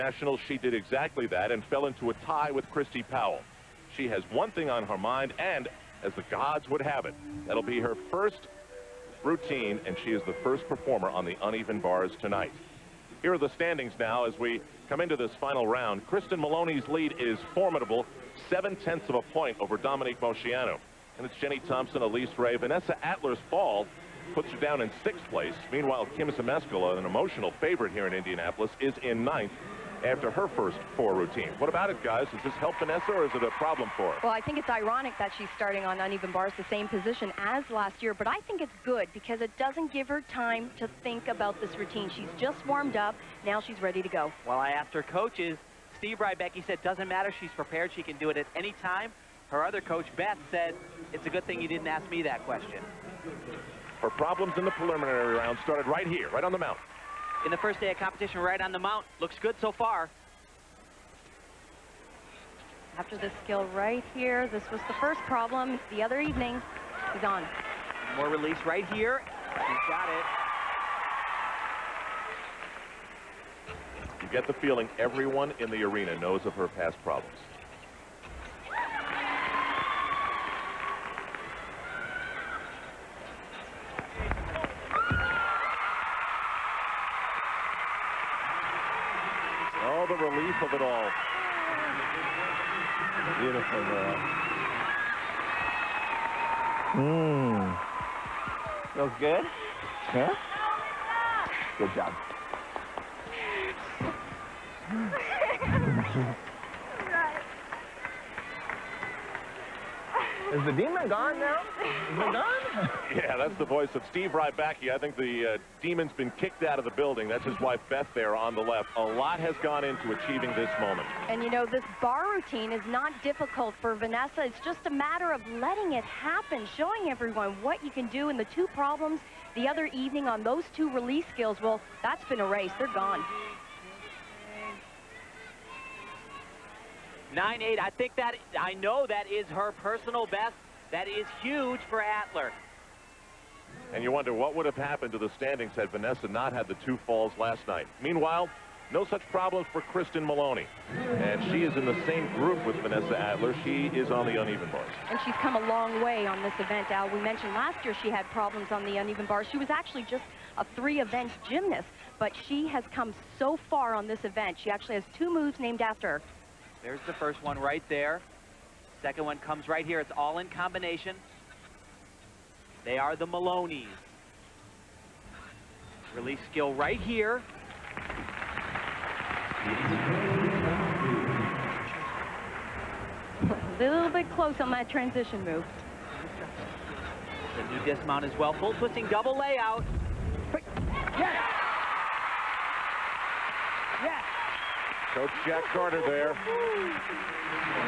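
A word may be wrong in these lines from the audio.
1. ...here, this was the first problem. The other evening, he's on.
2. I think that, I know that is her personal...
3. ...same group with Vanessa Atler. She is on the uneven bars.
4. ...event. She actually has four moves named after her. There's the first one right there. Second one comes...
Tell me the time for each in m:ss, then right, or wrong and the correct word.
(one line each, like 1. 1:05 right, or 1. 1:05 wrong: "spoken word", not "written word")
1. 1:04 right
2. 2:17 right
3. 2:32 right
4. 2:44 wrong: "two", not "four".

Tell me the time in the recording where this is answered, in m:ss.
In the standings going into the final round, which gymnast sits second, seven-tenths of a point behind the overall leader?
0:19.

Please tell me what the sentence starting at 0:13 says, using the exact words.
Here are the standings now as we come into this final round.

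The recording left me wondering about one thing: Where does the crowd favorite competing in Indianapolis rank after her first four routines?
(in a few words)
9th.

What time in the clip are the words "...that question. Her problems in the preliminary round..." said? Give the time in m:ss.
0:52.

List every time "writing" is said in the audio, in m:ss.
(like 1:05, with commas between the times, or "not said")
not said.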